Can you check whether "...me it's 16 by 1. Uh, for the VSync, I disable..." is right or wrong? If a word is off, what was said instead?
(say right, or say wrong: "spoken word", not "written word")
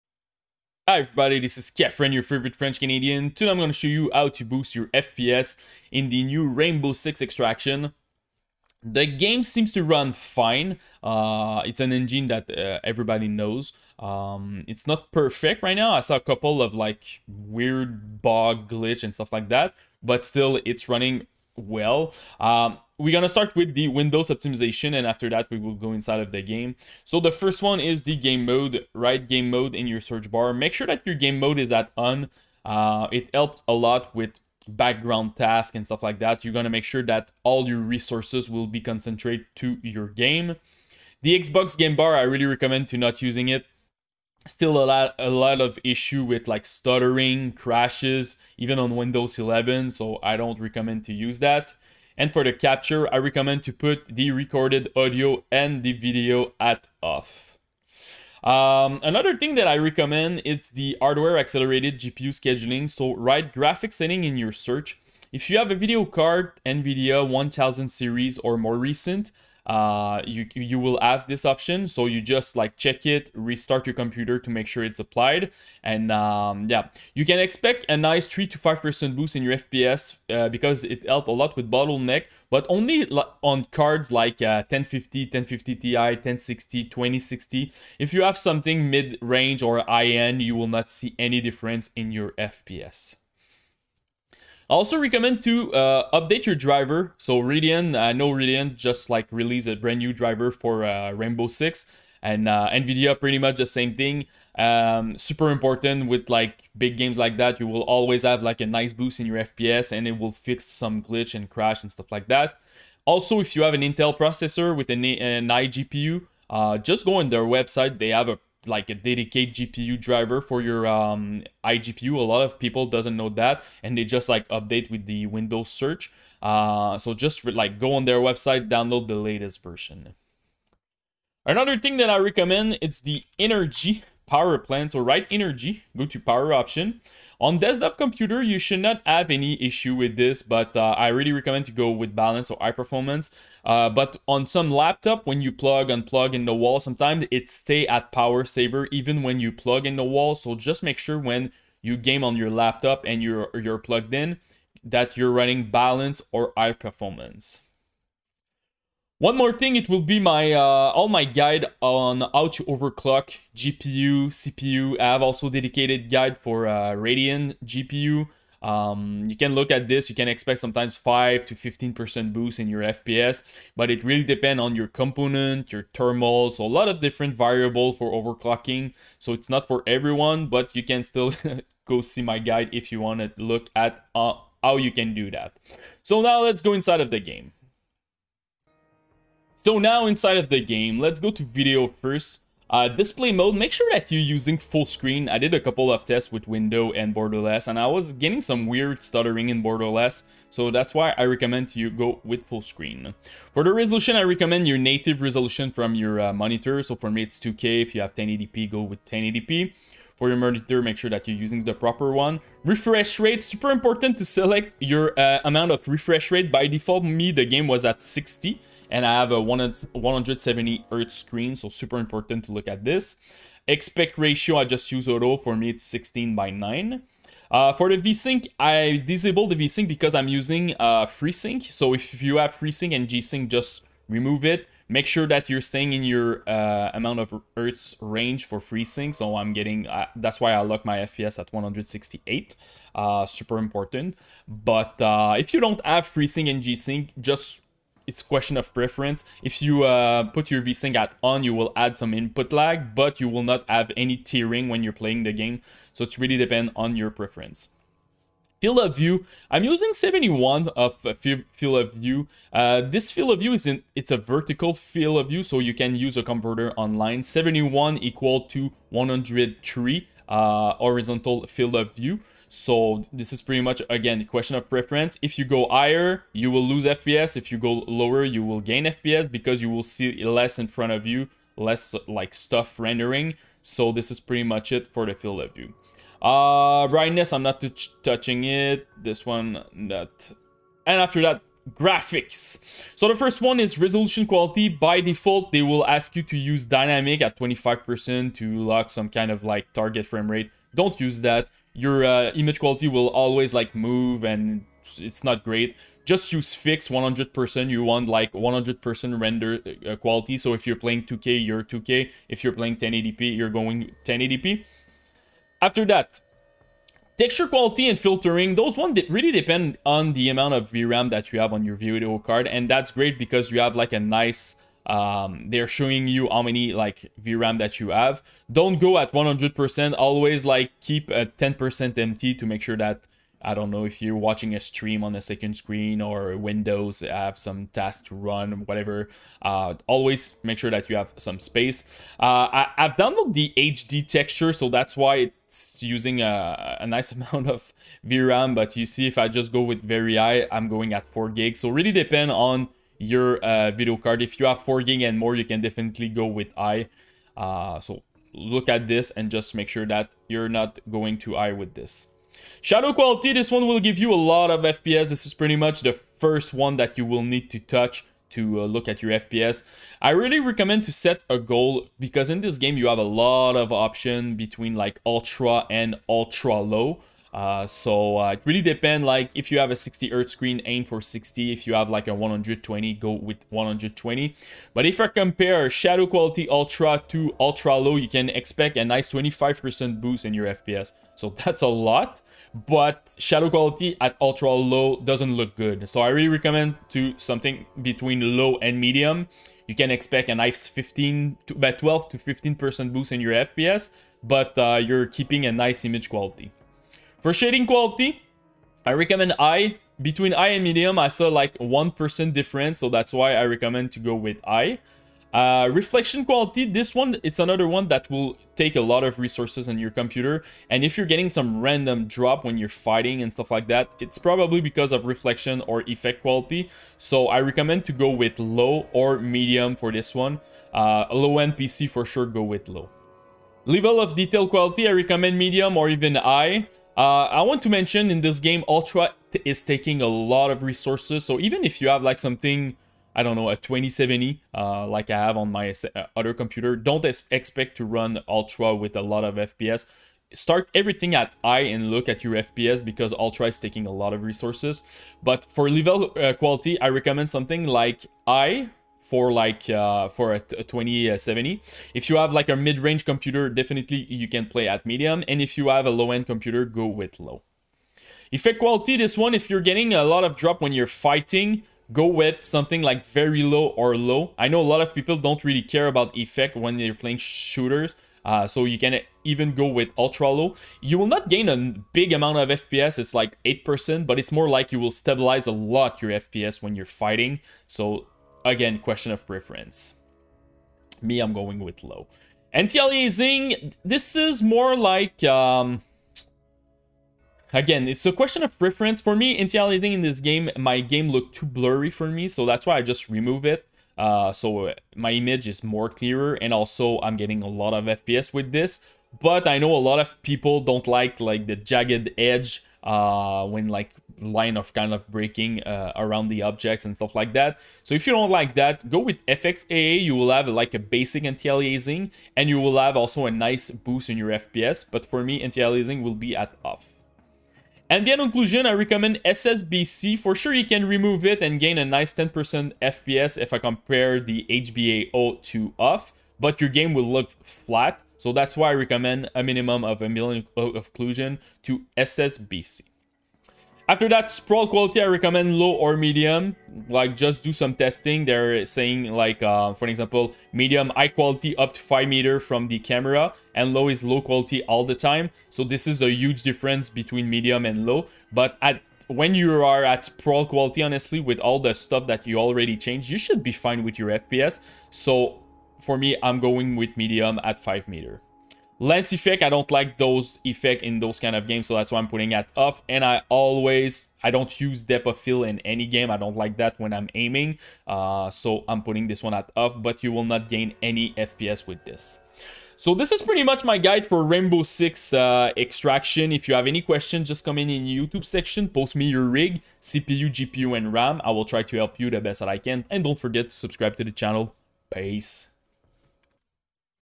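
wrong: "9", not "1".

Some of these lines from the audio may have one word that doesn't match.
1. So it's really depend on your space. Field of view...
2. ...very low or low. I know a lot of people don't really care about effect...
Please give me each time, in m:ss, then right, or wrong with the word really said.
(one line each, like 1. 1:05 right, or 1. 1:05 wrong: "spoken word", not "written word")
1. 4:15 wrong: "preference", not "space"
2. 7:53 right.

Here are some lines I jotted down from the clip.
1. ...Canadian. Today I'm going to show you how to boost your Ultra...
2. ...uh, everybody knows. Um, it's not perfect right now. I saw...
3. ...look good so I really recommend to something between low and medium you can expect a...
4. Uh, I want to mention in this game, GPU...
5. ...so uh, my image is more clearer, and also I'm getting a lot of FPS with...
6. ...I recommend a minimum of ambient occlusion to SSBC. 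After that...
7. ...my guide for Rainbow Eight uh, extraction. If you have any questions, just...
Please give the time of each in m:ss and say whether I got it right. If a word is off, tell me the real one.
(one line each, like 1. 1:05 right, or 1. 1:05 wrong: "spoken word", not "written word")
1. 0:02 wrong: "FPS", not "Ultra"
2. 0:12 right
3. 6:35 right
4. 7:16 wrong: "Ultra", not "GPU"
5. 8:24 right
6. 8:58 right
7. 9:43 wrong: "Six", not "Eight".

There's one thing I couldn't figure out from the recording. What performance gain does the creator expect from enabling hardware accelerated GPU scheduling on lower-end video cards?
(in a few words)
3 to 5%.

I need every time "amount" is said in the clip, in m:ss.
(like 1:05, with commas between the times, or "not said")
3:35, 3:56, 5:20, 5:47, 8:02.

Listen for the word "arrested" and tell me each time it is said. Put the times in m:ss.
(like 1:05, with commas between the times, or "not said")
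not said.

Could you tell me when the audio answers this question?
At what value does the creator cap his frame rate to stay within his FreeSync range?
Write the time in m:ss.
4:01.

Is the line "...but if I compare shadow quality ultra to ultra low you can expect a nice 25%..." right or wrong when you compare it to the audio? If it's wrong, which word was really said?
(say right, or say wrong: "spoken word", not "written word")
right.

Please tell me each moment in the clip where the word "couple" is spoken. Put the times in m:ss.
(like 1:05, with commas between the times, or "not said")
0:16, 3:15.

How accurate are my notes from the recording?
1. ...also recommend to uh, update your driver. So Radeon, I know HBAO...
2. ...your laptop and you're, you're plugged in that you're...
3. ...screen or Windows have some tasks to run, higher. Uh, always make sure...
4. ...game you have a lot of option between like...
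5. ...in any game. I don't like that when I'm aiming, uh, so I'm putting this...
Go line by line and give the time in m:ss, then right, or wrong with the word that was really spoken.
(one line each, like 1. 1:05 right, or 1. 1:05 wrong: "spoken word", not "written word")
1. 1:34 wrong: "Radeon", not "HBAO"
2. 2:32 right
3. 5:35 wrong: "whatever", not "higher"
4. 6:12 right
5. 9:35 right.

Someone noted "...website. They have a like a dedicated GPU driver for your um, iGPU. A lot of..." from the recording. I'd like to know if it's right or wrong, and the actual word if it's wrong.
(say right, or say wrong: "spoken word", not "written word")
right.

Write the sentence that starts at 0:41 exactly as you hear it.
The Xbox game bar, I really recommend to not using it.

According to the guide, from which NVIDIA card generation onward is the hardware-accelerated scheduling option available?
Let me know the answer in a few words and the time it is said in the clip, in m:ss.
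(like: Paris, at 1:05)
1000 series, at 1:07.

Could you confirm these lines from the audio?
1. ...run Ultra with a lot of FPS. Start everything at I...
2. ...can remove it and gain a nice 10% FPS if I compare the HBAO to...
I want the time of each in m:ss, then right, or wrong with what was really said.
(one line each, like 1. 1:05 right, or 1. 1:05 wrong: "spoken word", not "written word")
1. 7:27 right
2. 8:50 right.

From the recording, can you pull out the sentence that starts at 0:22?
Um, we're gonna start with the Windows optimization and after that we will go inside of the game.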